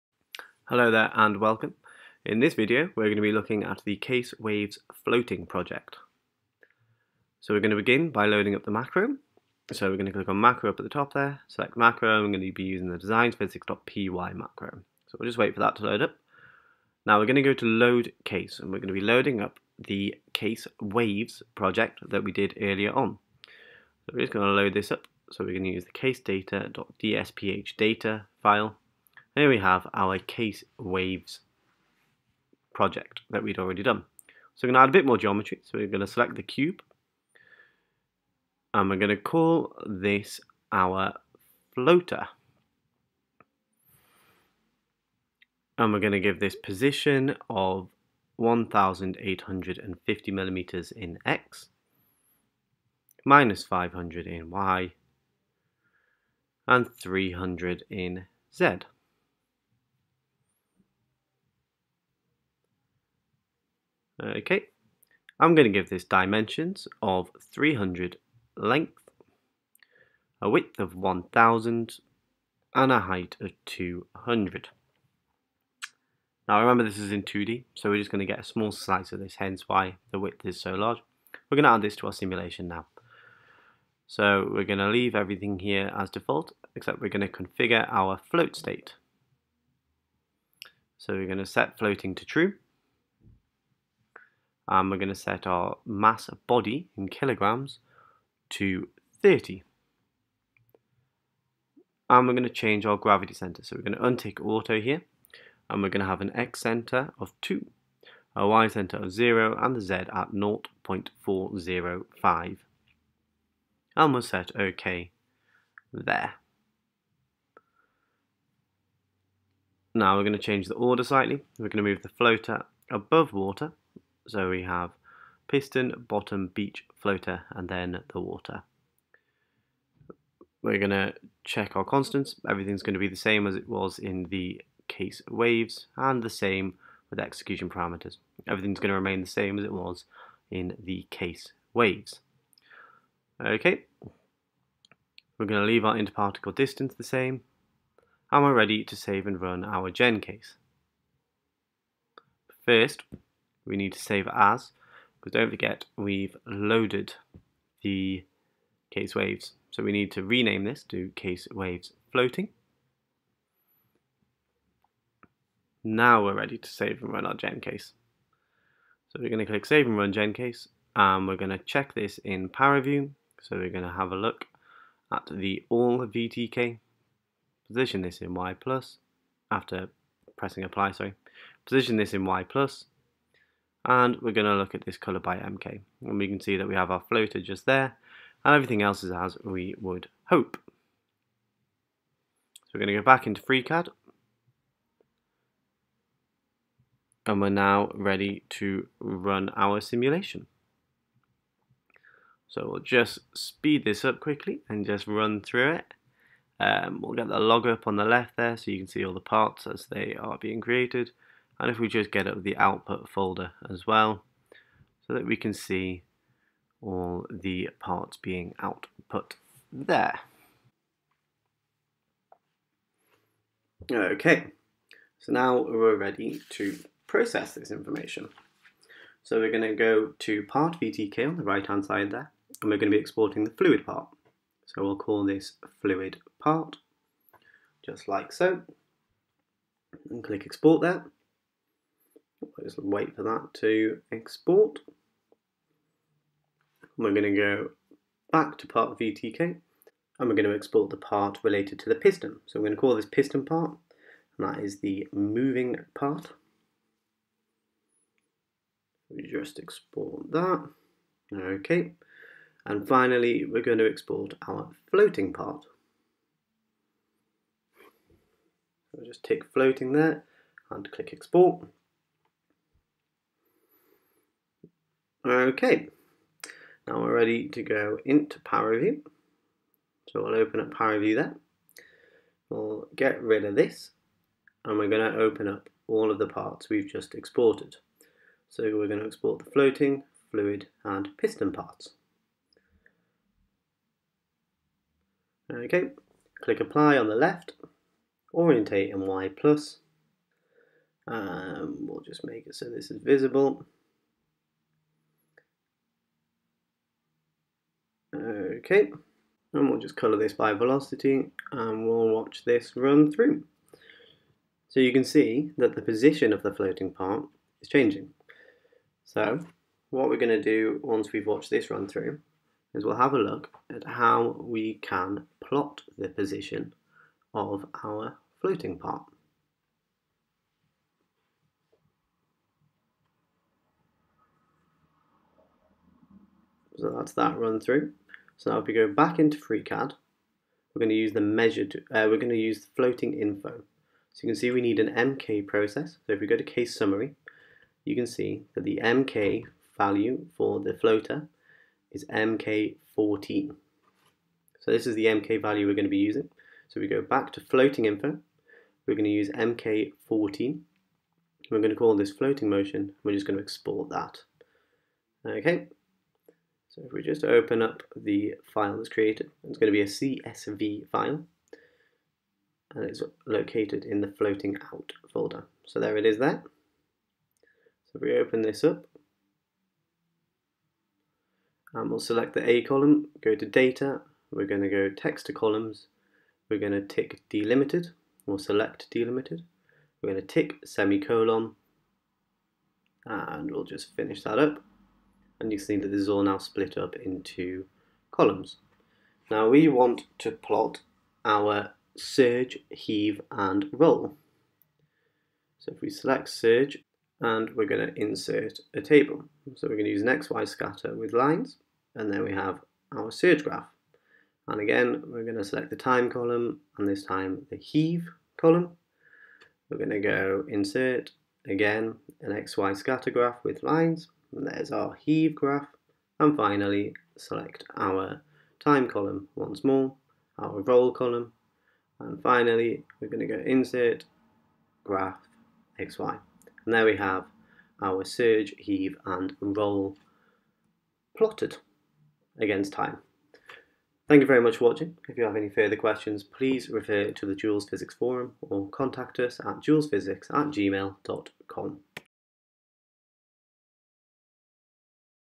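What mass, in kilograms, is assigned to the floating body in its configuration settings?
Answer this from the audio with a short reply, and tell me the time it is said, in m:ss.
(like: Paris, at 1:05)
30, at 1:39.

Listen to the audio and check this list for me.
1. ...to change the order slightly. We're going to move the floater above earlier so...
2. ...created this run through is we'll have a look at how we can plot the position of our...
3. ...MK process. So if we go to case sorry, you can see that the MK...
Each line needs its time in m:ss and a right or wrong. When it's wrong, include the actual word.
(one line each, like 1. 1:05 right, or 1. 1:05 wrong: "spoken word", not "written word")
1. 2:00 wrong: "water", not "earlier"
2. 5:21 wrong: "watched", not "created"
3. 5:44 wrong: "summary", not "sorry".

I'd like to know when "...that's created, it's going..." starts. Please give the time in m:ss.
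6:08.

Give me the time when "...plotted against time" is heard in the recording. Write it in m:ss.
7:21.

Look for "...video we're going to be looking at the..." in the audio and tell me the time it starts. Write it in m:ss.
0:02.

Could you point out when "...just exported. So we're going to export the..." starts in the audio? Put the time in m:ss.
4:46.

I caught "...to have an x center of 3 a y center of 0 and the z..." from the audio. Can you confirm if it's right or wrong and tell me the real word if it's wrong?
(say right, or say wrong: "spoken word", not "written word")
wrong: "2", not "3".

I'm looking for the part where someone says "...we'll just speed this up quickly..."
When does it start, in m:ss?
3:22.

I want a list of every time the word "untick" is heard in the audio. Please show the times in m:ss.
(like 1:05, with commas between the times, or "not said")
1:44.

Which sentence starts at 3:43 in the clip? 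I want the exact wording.
Okay, so now we're ready to process this information.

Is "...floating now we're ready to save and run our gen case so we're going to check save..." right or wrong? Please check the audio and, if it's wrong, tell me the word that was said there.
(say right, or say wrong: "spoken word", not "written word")
wrong: "click", not "check".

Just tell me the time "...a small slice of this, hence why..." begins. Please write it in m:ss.
1:18.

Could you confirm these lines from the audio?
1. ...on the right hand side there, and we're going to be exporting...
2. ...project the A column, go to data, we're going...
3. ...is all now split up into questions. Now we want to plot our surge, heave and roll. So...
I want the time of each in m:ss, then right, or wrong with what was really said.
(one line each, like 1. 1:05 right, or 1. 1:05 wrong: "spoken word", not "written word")
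1. 3:51 right
2. 6:21 wrong: "select", not "project"
3. 6:36 wrong: "columns", not "questions".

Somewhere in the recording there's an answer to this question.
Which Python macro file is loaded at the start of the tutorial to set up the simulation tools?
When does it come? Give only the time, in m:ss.
0:12.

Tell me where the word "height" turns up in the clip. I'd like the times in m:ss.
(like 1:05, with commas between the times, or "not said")
1:12.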